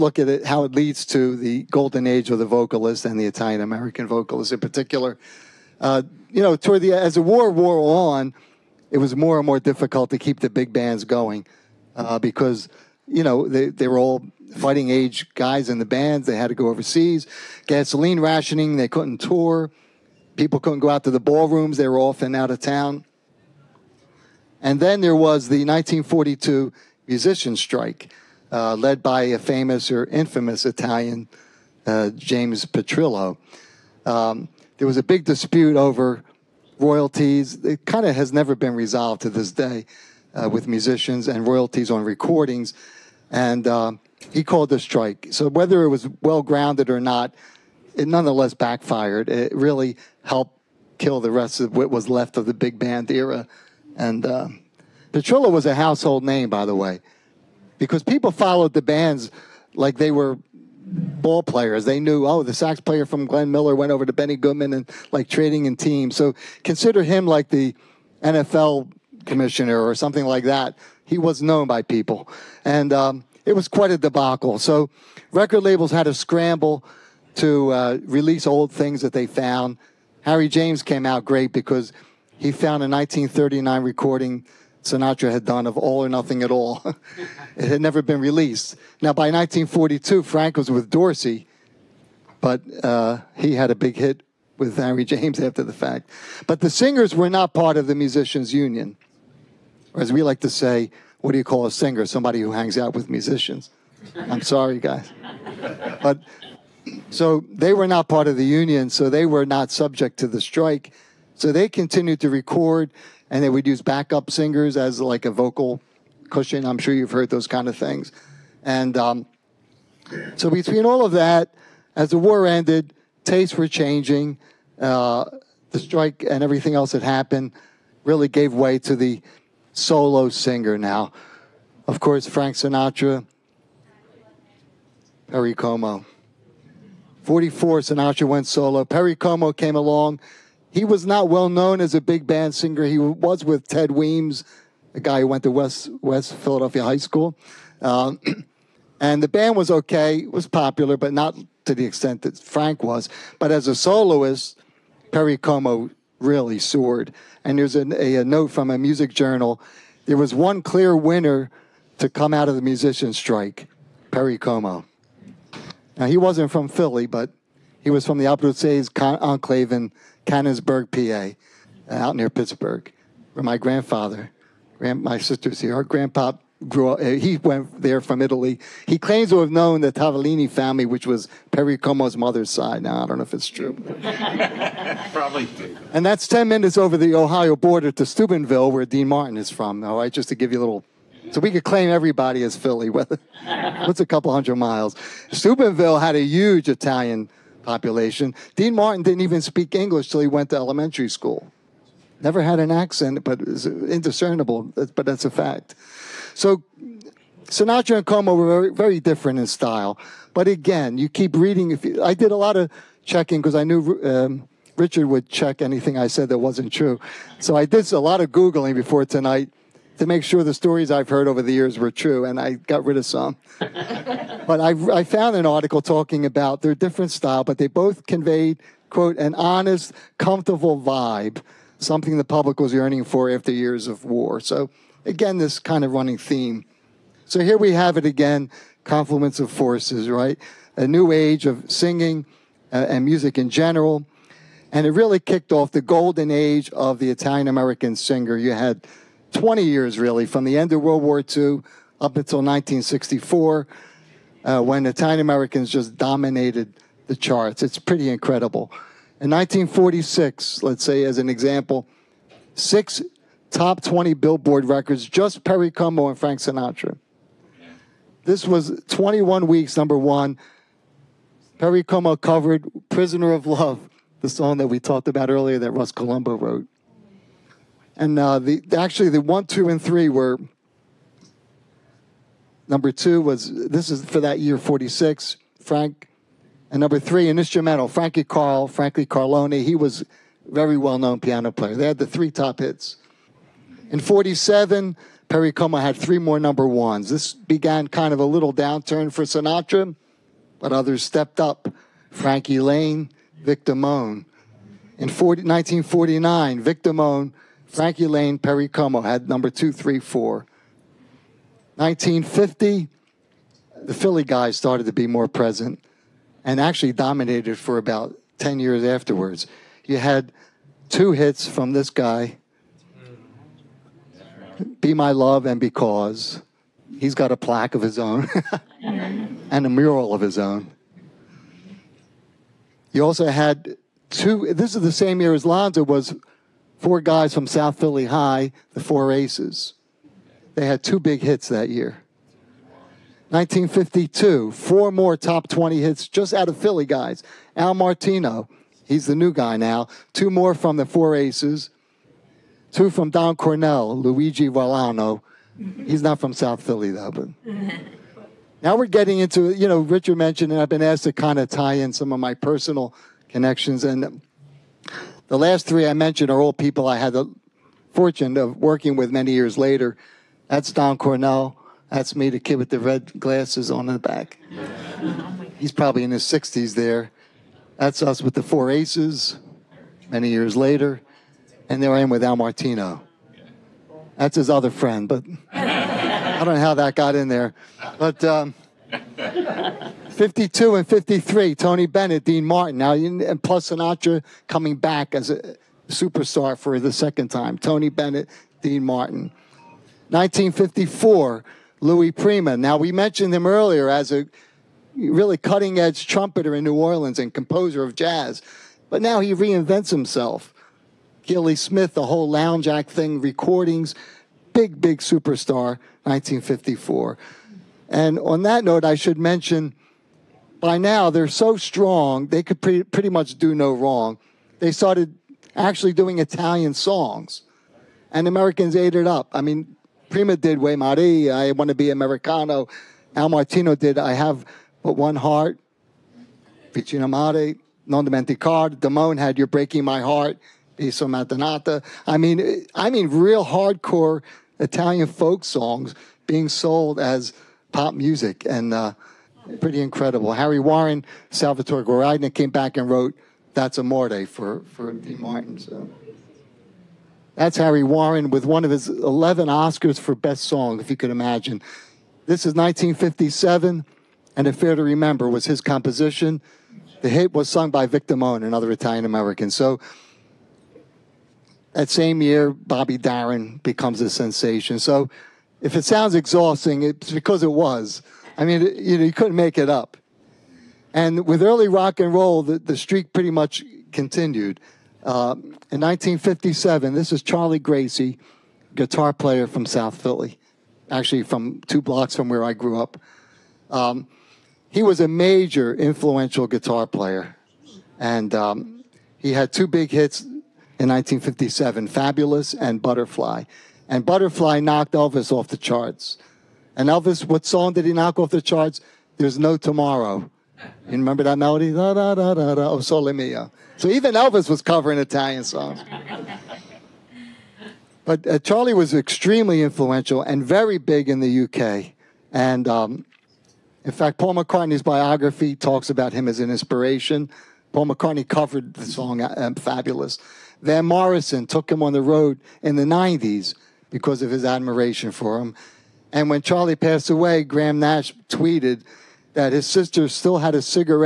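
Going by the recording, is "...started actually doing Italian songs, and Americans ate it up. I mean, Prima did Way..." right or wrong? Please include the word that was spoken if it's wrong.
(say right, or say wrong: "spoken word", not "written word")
right.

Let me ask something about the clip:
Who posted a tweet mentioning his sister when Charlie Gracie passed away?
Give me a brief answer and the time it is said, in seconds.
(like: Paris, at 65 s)
Graham Nash, at 537 s.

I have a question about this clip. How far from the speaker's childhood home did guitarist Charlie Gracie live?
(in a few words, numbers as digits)
Two blocks.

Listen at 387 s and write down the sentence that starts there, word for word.
But um, 52 and 53, Tony Bennett, Dean Martin.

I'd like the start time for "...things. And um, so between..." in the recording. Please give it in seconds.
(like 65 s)
117 s.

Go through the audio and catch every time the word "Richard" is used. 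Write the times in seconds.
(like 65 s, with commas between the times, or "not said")
214 s, 359 s.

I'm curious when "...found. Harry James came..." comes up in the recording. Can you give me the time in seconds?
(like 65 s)
79 s.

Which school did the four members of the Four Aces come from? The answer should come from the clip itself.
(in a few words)
South Philly High.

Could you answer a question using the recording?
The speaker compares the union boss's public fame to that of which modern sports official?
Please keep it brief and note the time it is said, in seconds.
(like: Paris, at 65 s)
NFL commissioner, at 68 s.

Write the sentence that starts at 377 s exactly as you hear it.
That's us with the four aces many years later and they were in with Al Martino.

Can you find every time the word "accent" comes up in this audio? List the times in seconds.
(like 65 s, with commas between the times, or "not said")
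202 s.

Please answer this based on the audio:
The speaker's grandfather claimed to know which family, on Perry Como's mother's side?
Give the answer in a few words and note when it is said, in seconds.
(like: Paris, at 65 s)
Tavolini, at 179 s.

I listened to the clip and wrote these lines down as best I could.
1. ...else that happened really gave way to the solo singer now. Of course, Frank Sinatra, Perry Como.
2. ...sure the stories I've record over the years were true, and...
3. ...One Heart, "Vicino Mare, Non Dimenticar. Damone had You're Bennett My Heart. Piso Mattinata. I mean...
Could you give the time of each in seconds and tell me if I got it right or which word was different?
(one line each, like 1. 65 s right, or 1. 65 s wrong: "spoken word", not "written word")
1. 126 s right
2. 220 s wrong: "heard", not "record"
3. 434 s wrong: "Breaking", not "Bennett".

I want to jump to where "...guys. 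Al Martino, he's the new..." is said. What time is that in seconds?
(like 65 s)
346 s.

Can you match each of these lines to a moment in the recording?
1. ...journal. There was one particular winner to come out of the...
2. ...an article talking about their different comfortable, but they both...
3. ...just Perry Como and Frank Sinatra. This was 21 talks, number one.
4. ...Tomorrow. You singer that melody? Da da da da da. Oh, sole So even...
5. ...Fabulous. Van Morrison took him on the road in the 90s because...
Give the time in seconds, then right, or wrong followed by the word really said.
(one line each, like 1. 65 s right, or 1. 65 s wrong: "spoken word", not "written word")
1. 159 s wrong: "clear", not "particular"
2. 225 s wrong: "style", not "comfortable"
3. 265 s wrong: "weeks", not "talks"
4. 509 s wrong: "remember", not "singer"
5. 529 s right.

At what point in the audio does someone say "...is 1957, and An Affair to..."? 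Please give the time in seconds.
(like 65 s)
462 s.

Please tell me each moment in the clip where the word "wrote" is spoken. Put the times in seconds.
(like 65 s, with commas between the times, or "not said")
276 s, 452 s.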